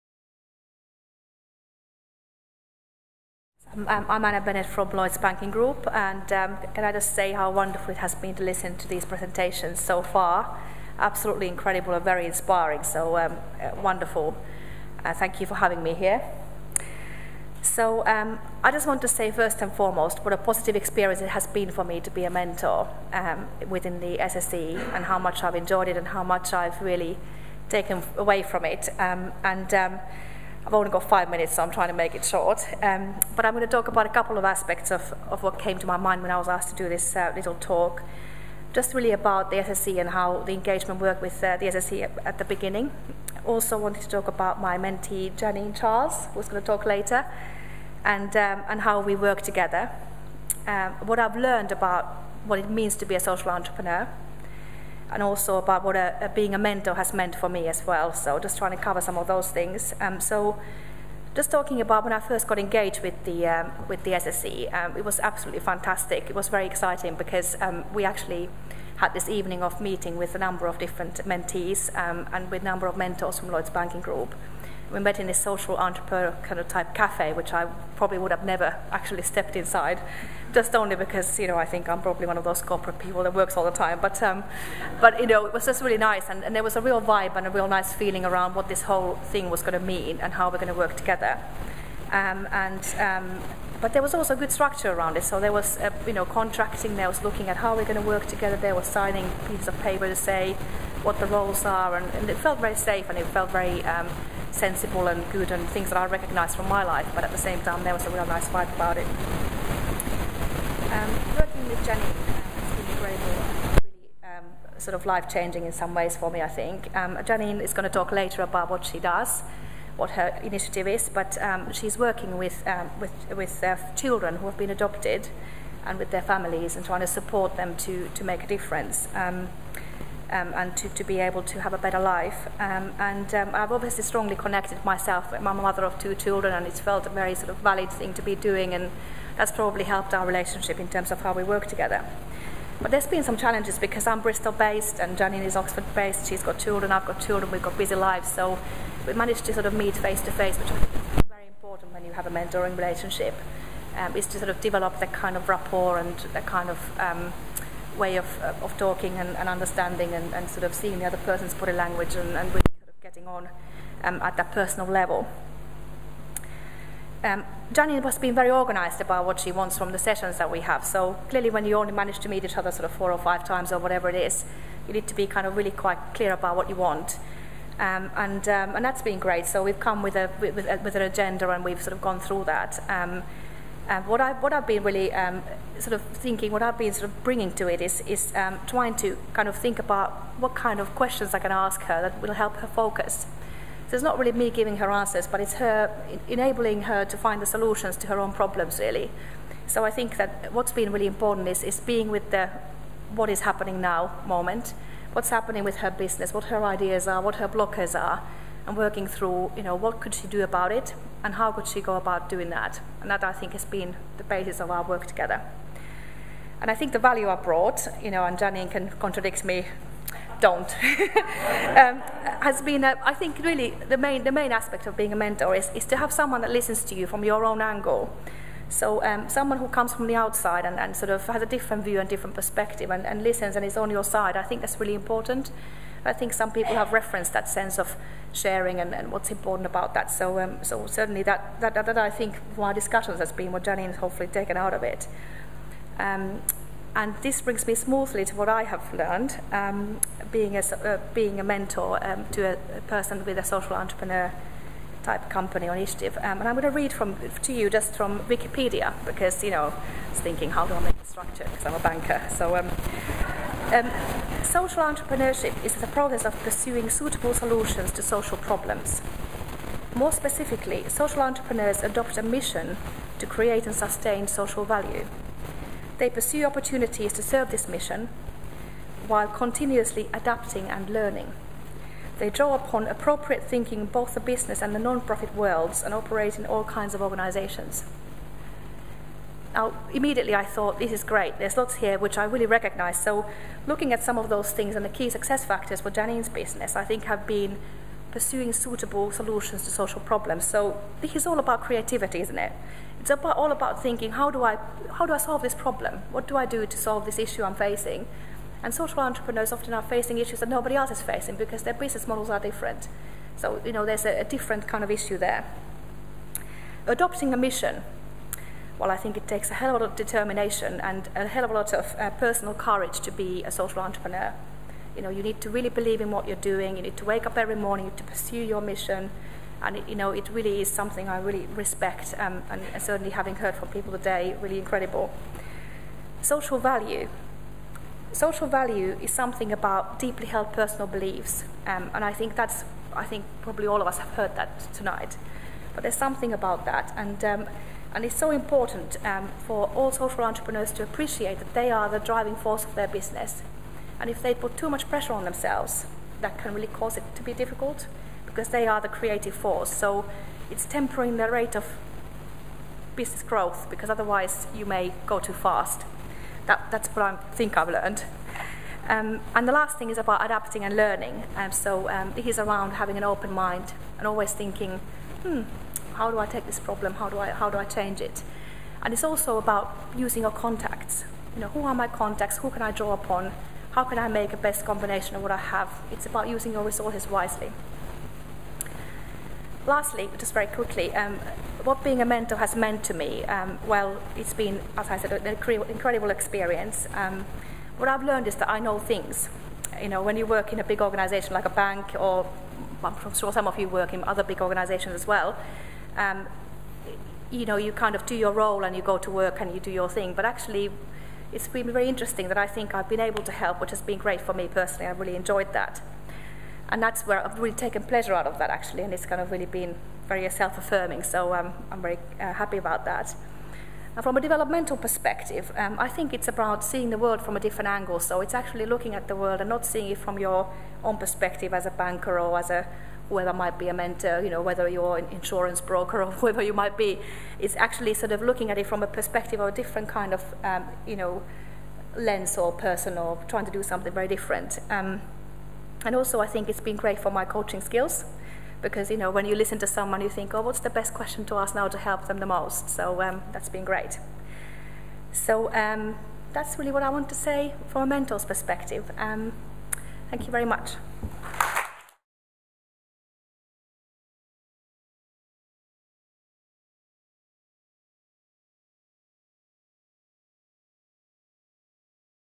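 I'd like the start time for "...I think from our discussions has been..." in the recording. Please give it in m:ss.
4:01.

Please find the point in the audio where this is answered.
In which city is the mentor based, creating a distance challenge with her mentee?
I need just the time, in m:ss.
2:24.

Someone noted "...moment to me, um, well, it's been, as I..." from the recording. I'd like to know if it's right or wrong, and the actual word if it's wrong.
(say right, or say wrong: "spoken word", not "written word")
wrong: "meant", not "moment".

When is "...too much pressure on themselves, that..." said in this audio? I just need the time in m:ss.
5:54.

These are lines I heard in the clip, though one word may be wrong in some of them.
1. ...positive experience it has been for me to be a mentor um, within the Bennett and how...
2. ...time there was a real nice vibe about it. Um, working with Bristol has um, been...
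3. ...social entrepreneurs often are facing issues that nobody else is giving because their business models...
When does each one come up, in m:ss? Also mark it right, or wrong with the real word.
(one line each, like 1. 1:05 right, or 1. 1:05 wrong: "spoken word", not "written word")
1. 0:20 wrong: "SSE", not "Bennett"
2. 1:47 wrong: "Jenny", not "Bristol"
3. 5:08 wrong: "facing", not "giving".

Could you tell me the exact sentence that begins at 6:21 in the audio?
You know, who are my contacts?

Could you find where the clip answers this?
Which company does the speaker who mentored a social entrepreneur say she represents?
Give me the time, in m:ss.
0:04.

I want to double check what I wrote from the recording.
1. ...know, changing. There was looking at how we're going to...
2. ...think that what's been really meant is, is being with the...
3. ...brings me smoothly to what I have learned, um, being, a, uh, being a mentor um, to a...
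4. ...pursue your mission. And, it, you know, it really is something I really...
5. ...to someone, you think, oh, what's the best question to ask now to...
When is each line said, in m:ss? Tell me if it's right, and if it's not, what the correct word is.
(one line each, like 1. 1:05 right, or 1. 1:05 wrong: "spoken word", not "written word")
1. 1:36 wrong: "contracting", not "changing"
2. 3:19 wrong: "important", not "meant"
3. 4:07 right
4. 5:28 right
5. 7:29 right.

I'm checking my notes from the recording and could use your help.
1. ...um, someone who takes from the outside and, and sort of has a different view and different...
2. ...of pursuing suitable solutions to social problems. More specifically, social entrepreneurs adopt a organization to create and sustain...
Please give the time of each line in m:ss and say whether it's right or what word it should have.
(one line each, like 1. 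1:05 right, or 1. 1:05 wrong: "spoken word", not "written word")
1. 3:49 wrong: "comes", not "takes"
2. 4:26 wrong: "mission", not "organization".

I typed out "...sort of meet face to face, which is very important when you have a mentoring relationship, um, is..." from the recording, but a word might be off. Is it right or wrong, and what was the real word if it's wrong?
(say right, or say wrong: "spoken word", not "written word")
right.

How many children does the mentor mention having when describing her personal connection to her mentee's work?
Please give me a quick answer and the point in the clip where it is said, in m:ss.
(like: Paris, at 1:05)
2, at 2:15.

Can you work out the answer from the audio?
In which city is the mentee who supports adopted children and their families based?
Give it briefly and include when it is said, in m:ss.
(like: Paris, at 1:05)
Oxford, at 2:25.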